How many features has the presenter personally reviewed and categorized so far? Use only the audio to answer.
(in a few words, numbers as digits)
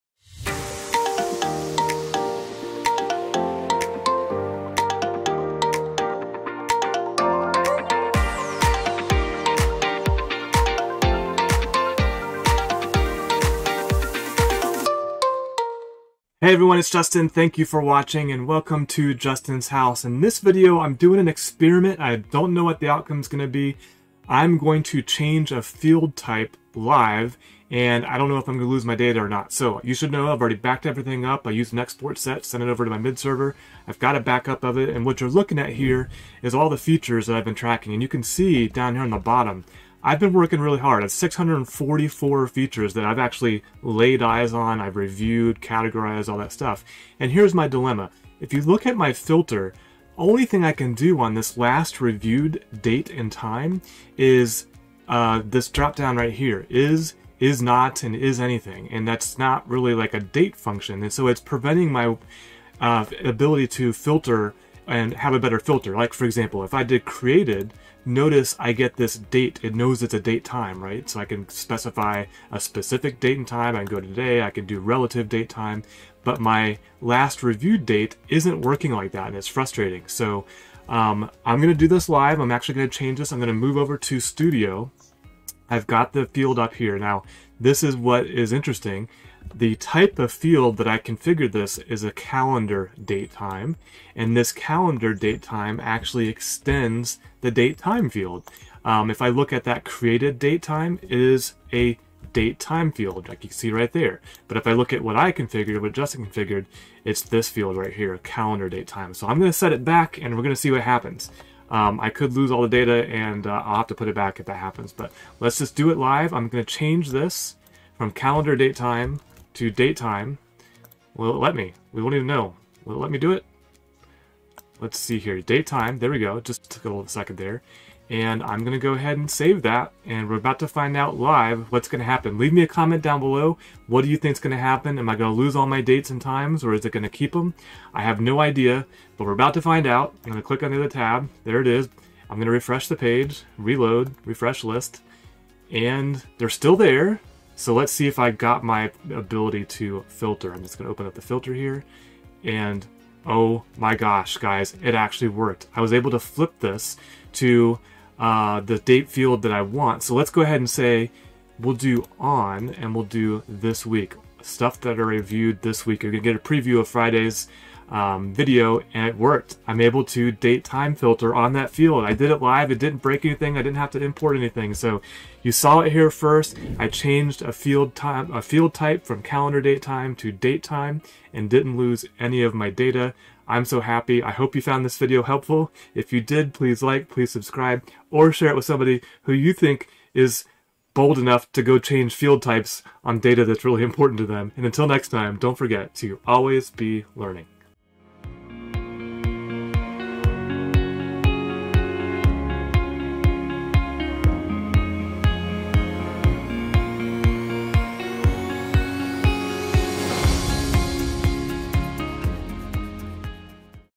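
644.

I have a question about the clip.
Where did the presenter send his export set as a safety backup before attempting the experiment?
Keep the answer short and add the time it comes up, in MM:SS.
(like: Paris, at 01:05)
mid server, at 00:32.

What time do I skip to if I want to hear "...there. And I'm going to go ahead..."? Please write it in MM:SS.
02:07.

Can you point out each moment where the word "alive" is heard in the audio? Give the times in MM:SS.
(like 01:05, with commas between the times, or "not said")
not said.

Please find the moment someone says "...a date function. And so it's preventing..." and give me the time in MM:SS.
01:00.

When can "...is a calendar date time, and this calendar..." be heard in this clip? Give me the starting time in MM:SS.
01:31.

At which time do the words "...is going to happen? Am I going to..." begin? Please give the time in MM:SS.
02:14.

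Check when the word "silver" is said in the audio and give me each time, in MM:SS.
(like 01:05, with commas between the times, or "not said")
not said.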